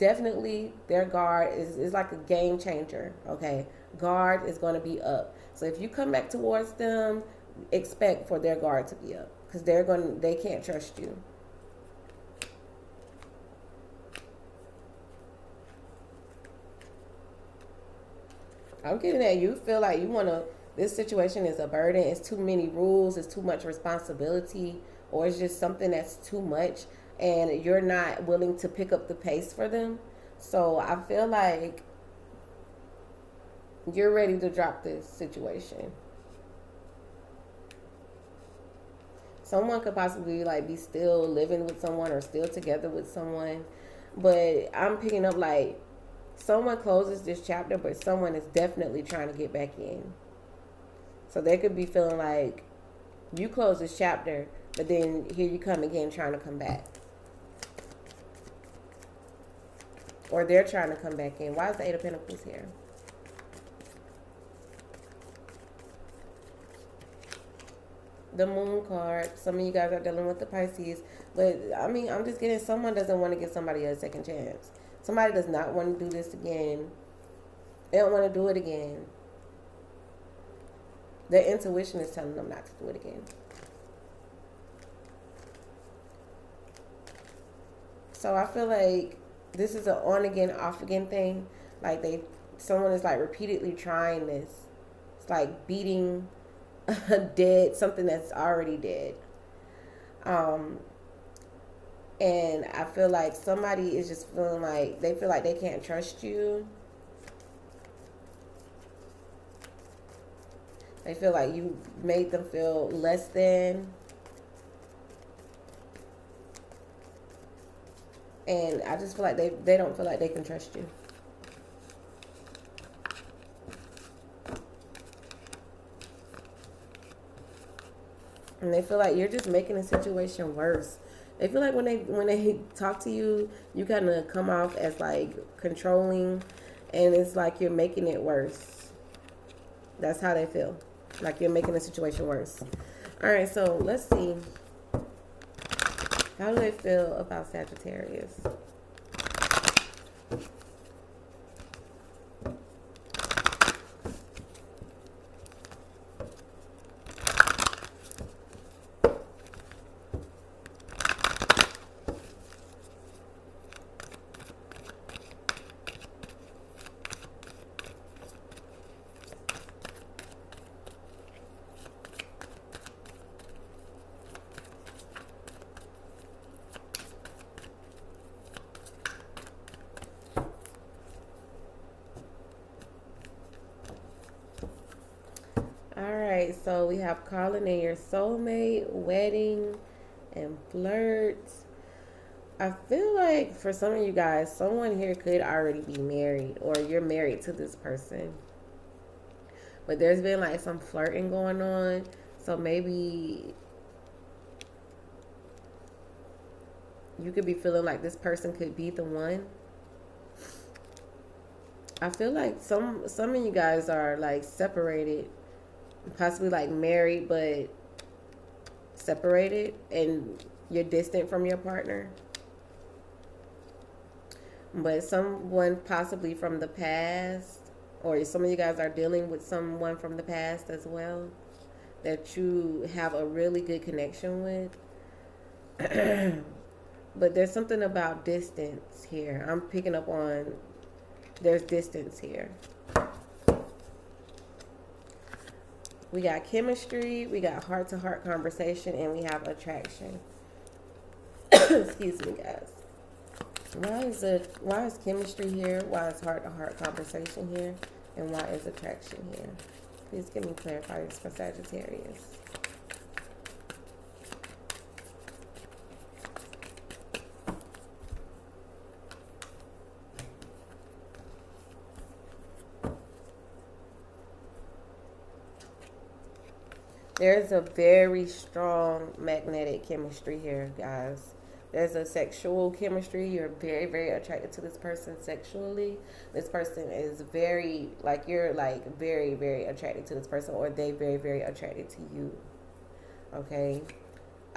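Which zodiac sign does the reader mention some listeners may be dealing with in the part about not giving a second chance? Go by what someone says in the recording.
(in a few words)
Pisces.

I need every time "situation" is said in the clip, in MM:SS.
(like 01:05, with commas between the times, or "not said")
00:20, 00:35, 02:09, 02:21.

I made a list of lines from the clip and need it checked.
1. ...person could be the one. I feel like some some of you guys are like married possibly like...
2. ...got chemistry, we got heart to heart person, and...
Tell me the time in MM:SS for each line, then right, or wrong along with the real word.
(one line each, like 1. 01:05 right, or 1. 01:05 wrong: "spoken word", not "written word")
1. 03:28 wrong: "separated", not "married"
2. 04:06 wrong: "conversation", not "person".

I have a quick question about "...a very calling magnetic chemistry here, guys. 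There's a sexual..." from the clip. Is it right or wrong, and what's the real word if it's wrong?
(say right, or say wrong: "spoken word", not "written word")
wrong: "strong", not "calling".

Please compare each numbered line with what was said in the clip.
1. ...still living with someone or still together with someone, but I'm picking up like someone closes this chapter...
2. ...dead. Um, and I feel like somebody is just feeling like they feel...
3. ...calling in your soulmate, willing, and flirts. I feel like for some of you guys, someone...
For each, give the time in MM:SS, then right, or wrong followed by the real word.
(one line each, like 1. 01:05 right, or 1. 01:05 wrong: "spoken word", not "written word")
1. 00:40 right
2. 01:38 right
3. 03:07 wrong: "wedding", not "willing".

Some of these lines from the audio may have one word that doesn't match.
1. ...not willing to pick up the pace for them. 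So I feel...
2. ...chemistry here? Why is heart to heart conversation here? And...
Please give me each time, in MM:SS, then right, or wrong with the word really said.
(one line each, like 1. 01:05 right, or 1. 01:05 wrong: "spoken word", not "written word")
1. 00:27 right
2. 04:15 right.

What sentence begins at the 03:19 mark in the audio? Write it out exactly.
But there's been like some flirting going on.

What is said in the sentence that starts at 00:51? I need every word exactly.
So they could be feeling like you close this chapter, but then here you come again trying to come back.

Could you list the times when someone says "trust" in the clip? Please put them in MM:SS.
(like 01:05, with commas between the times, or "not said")
00:10, 01:45, 02:00.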